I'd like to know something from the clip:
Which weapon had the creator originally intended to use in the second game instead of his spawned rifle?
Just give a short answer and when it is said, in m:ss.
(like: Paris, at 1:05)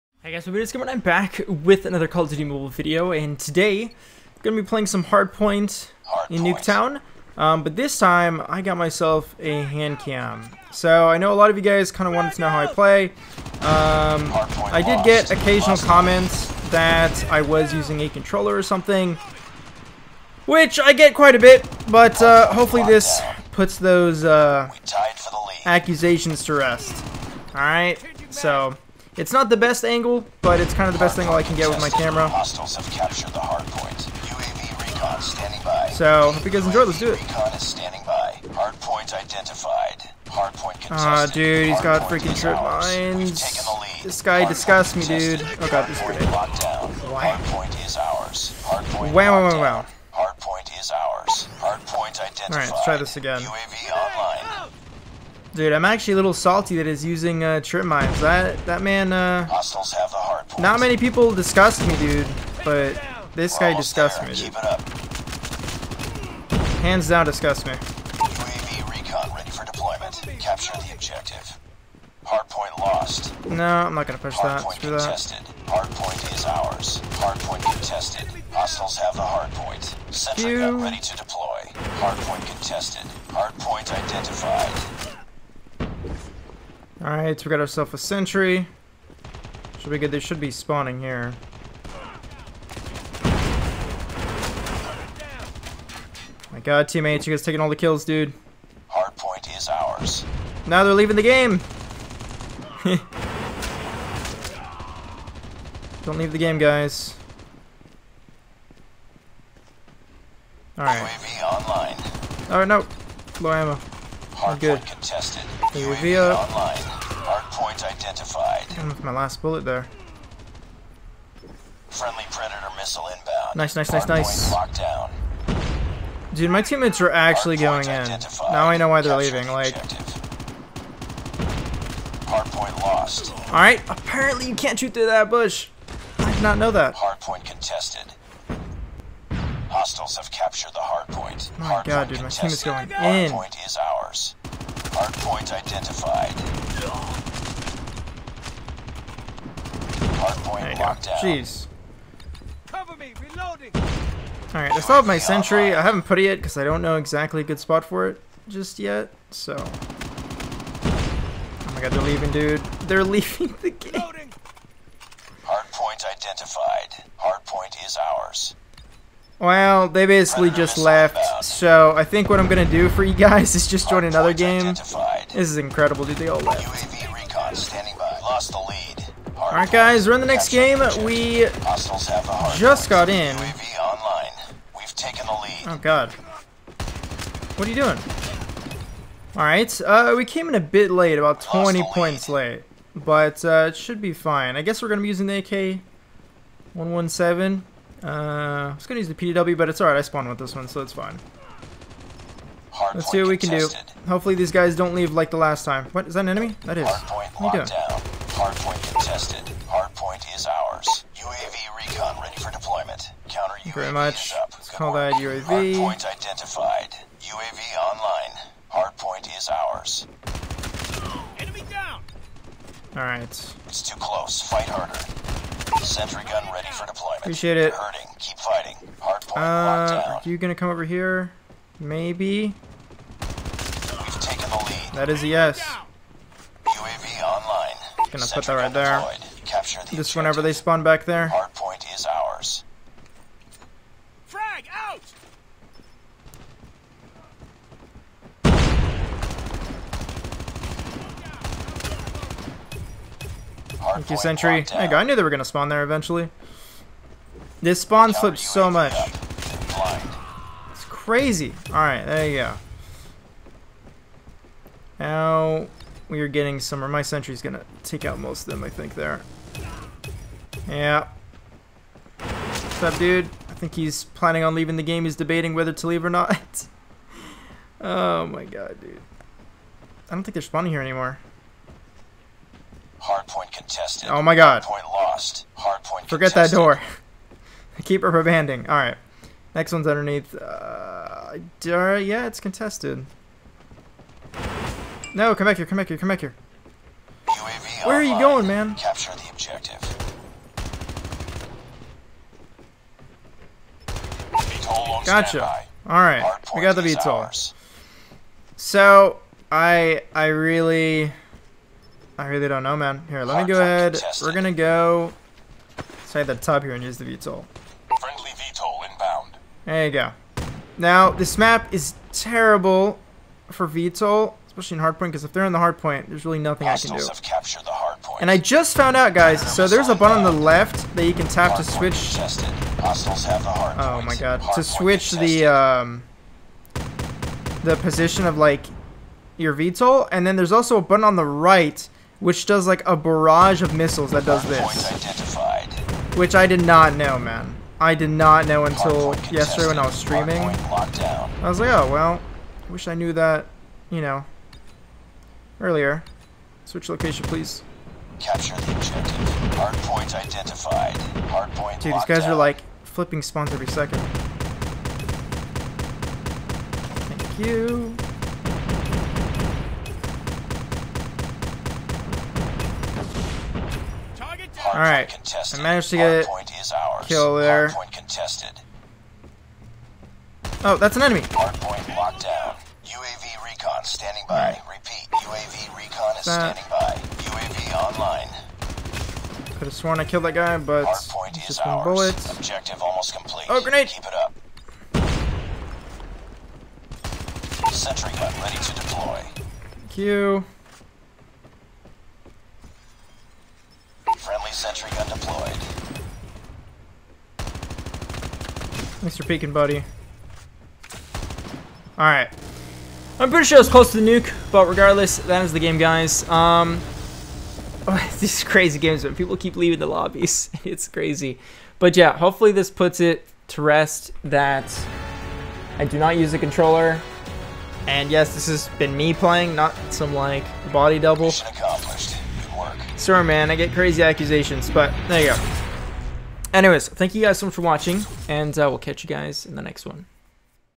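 PDW, at 3:19.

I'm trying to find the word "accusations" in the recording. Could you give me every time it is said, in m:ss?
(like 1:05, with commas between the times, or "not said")
0:25, 7:14.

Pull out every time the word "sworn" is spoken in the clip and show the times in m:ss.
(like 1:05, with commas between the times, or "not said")
6:29.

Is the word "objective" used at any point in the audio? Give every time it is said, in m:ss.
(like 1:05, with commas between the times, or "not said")
1:10, 4:59, 5:58, 6:32.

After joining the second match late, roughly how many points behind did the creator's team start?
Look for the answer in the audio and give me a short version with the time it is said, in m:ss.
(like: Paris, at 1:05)
20 points, at 3:11.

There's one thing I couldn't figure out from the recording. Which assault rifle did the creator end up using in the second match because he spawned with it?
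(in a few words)
AK-117.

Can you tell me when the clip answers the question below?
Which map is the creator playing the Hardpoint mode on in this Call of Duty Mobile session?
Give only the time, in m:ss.
0:06.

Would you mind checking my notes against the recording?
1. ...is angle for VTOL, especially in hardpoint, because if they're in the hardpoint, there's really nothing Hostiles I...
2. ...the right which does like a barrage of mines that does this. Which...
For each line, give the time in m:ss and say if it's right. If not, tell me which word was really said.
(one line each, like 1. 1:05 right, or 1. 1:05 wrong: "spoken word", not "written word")
1. 5:21 wrong: "terrible", not "angle"
2. 5:41 wrong: "missiles", not "mines".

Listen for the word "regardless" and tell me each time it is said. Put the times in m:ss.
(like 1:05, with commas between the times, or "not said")
6:54.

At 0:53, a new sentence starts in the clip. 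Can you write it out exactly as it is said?
UAV on Dude, I'm actually a little salty that he's using uh, trip mines.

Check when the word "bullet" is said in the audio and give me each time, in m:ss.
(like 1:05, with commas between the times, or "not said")
1:59, 6:31.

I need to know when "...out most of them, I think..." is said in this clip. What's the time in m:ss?
4:28.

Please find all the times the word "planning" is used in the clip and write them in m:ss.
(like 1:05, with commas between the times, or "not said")
4:34.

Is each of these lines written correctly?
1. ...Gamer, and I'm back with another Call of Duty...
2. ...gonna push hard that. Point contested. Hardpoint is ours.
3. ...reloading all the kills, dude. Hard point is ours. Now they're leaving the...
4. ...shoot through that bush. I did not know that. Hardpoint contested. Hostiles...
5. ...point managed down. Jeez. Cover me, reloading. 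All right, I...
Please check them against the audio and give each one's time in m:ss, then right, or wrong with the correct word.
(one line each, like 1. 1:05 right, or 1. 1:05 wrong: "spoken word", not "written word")
1. 0:00 right
2. 1:14 right
3. 1:37 wrong: "taking", not "reloading"
4. 2:14 right
5. 2:30 wrong: "locked", not "managed".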